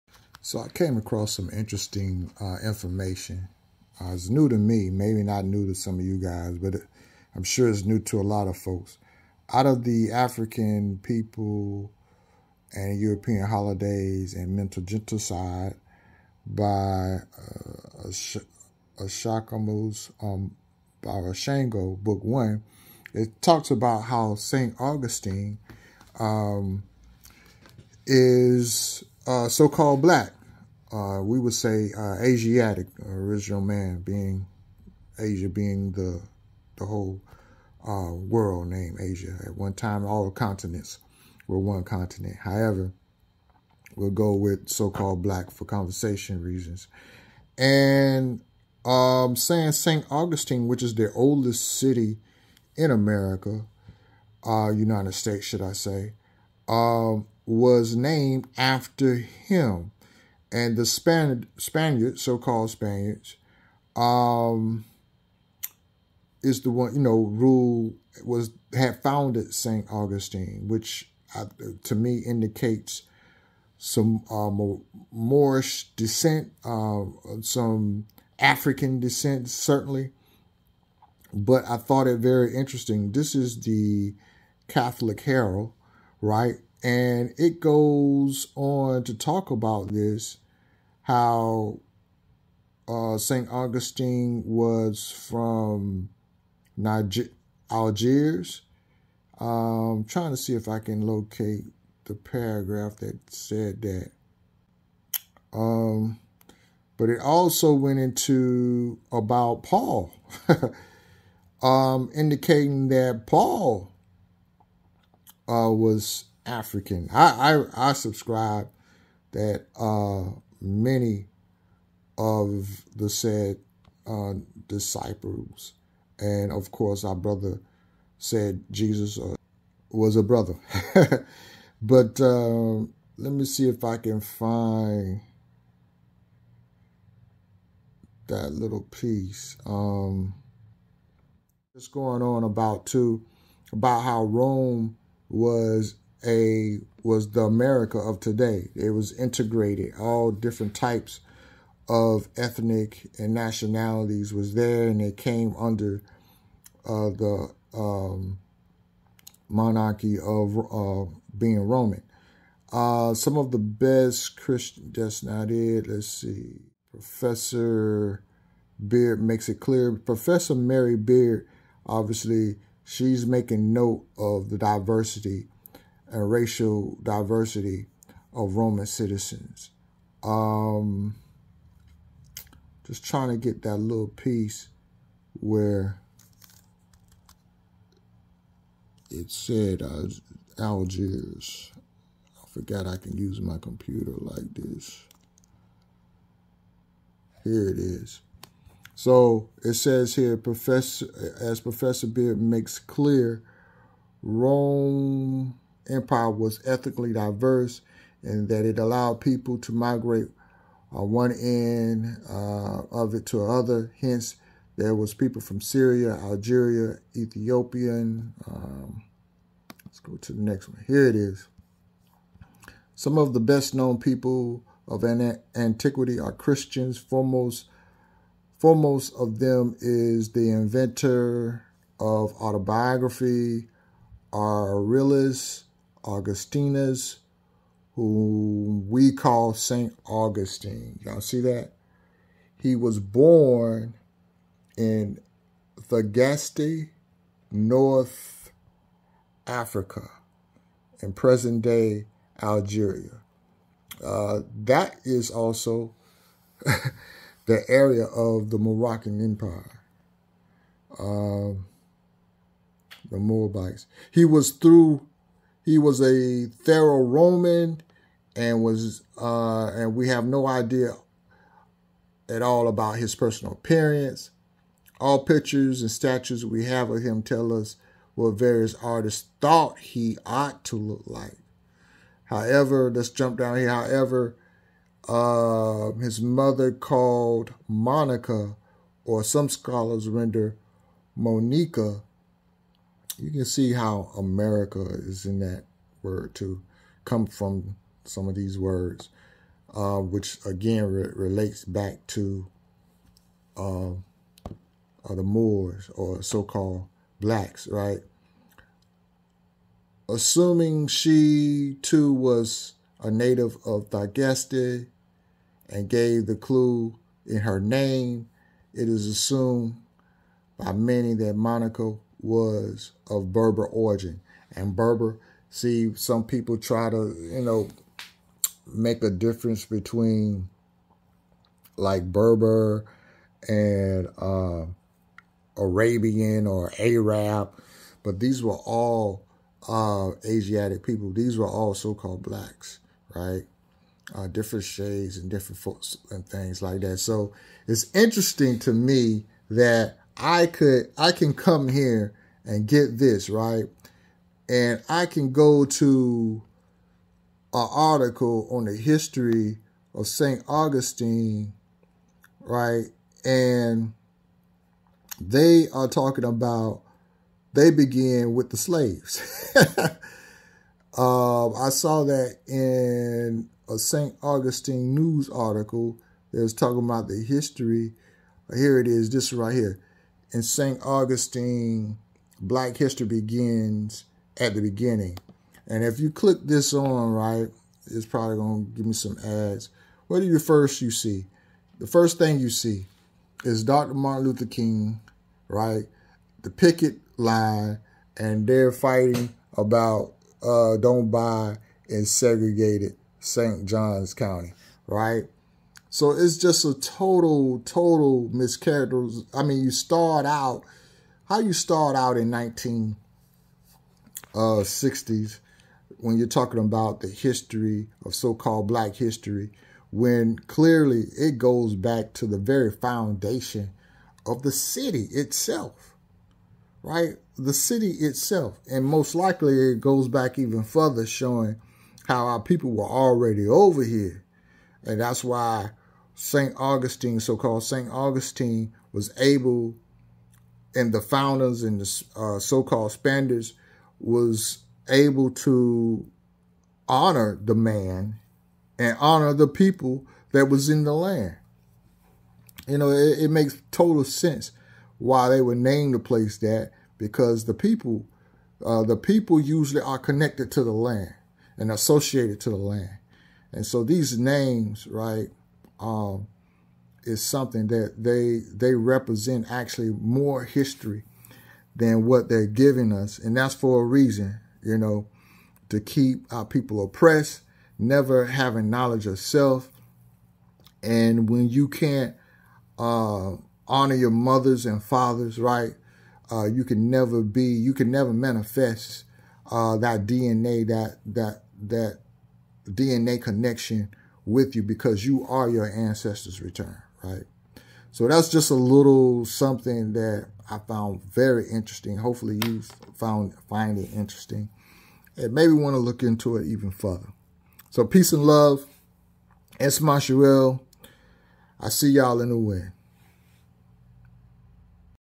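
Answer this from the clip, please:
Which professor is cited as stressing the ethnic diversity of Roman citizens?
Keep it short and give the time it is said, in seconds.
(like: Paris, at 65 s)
Mary Beard, at 170 s.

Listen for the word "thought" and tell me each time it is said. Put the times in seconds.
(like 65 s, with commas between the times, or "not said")
81 s, 279 s.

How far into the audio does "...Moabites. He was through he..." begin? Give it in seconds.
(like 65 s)
263 s.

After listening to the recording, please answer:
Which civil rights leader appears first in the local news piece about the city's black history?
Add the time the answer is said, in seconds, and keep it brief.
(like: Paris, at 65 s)
Dr. Martin Luther King, at 393 s.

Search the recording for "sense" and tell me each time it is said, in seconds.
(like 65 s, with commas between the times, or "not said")
454 s.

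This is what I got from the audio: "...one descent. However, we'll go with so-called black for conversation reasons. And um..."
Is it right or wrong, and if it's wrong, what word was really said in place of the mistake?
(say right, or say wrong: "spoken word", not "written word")
wrong: "continent", not "descent".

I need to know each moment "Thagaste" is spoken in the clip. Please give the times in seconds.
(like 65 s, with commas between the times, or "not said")
245 s, 313 s.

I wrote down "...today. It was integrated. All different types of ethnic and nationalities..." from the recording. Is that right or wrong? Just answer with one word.
right.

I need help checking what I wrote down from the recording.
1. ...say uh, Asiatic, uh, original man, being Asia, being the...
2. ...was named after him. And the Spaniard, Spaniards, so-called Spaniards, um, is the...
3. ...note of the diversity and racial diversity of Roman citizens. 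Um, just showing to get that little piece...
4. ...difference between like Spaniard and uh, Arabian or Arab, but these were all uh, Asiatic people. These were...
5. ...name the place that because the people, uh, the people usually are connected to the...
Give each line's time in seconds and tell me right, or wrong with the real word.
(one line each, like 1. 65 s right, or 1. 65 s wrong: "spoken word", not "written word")
1. 31 s right
2. 57 s right
3. 173 s wrong: "trying", not "showing"
4. 329 s wrong: "Berber", not "Spaniard"
5. 455 s right.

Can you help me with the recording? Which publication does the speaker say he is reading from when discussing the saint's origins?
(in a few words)
The Catholic Herald.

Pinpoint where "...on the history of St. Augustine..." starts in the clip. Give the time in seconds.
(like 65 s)
358 s.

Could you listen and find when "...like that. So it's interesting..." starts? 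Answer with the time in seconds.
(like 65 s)
346 s.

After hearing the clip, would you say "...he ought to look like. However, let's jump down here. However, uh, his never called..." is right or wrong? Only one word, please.
wrong.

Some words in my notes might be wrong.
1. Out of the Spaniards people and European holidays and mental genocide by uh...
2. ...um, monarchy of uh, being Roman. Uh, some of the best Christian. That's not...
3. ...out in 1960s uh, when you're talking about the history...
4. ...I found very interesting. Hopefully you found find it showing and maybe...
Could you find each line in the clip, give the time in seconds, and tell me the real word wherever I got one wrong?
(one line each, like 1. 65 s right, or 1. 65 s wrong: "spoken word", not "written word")
1. 9 s wrong: "African", not "Spaniards"
2. 157 s right
3. 411 s right
4. 500 s wrong: "interesting", not "showing".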